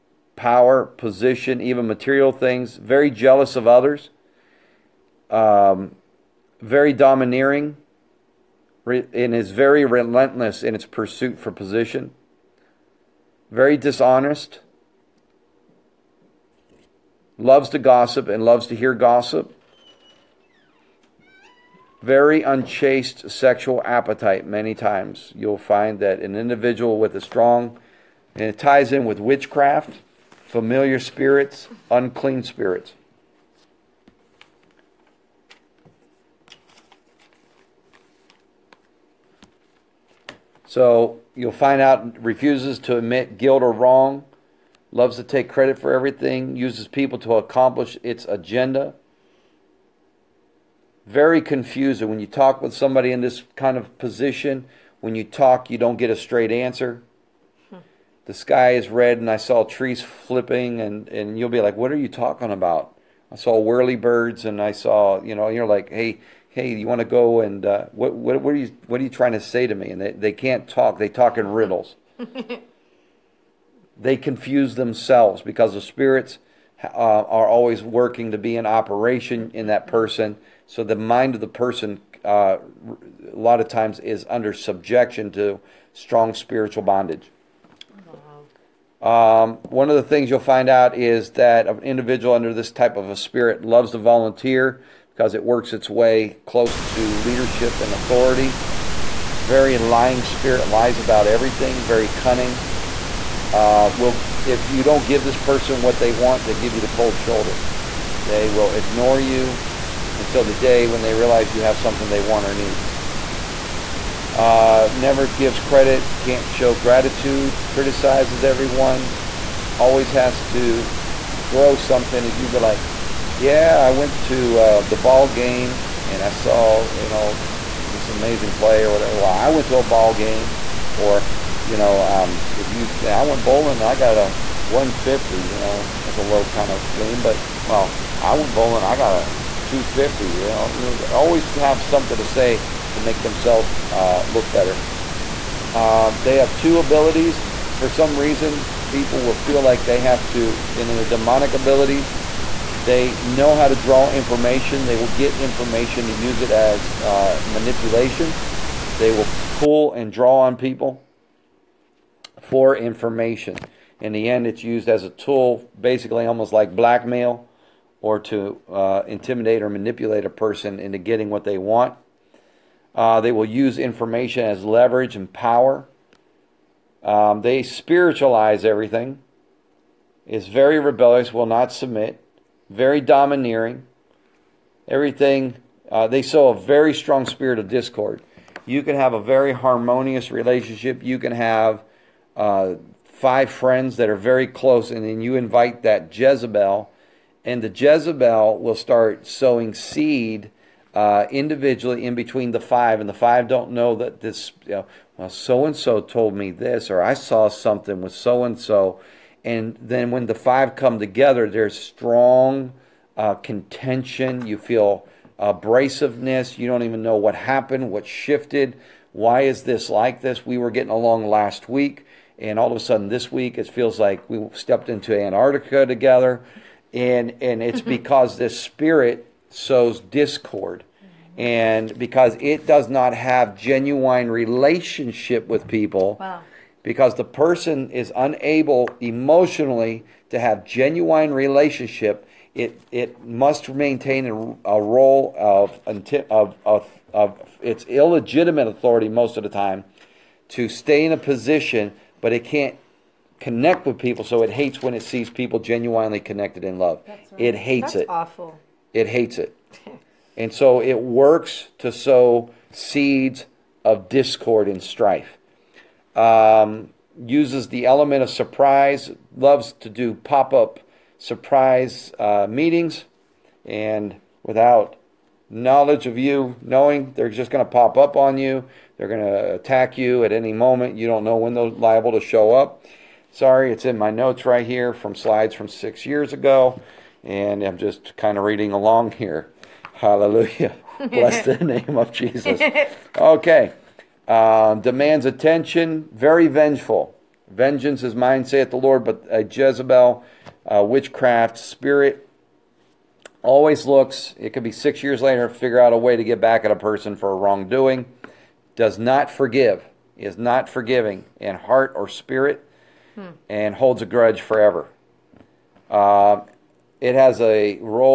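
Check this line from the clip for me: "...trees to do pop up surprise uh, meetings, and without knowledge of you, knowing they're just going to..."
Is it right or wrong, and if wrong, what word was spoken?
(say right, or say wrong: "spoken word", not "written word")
wrong: "loves", not "trees".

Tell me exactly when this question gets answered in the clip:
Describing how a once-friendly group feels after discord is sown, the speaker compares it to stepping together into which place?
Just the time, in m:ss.
3:45.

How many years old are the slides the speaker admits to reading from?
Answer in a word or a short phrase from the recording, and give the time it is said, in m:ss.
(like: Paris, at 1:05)
6, at 4:45.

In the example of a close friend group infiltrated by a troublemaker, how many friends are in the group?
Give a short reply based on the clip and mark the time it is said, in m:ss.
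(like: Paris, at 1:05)
5, at 3:13.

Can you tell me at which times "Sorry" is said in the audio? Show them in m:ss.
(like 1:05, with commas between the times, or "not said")
4:43.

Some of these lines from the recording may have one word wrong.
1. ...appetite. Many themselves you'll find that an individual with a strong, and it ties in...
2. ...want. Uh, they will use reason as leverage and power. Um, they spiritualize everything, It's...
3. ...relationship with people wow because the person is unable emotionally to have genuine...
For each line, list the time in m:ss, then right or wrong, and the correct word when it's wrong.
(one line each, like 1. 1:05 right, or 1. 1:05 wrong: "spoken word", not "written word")
1. 0:23 wrong: "times", not "themselves"
2. 2:51 wrong: "information", not "reason"
3. 3:54 right.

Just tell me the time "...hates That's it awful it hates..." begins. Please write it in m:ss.
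4:17.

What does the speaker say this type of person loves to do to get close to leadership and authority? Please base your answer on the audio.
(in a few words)
volunteer.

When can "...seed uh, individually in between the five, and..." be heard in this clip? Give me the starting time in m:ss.
3:19.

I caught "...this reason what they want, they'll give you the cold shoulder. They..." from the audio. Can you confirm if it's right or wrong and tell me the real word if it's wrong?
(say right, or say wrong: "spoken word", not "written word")
wrong: "person", not "reason".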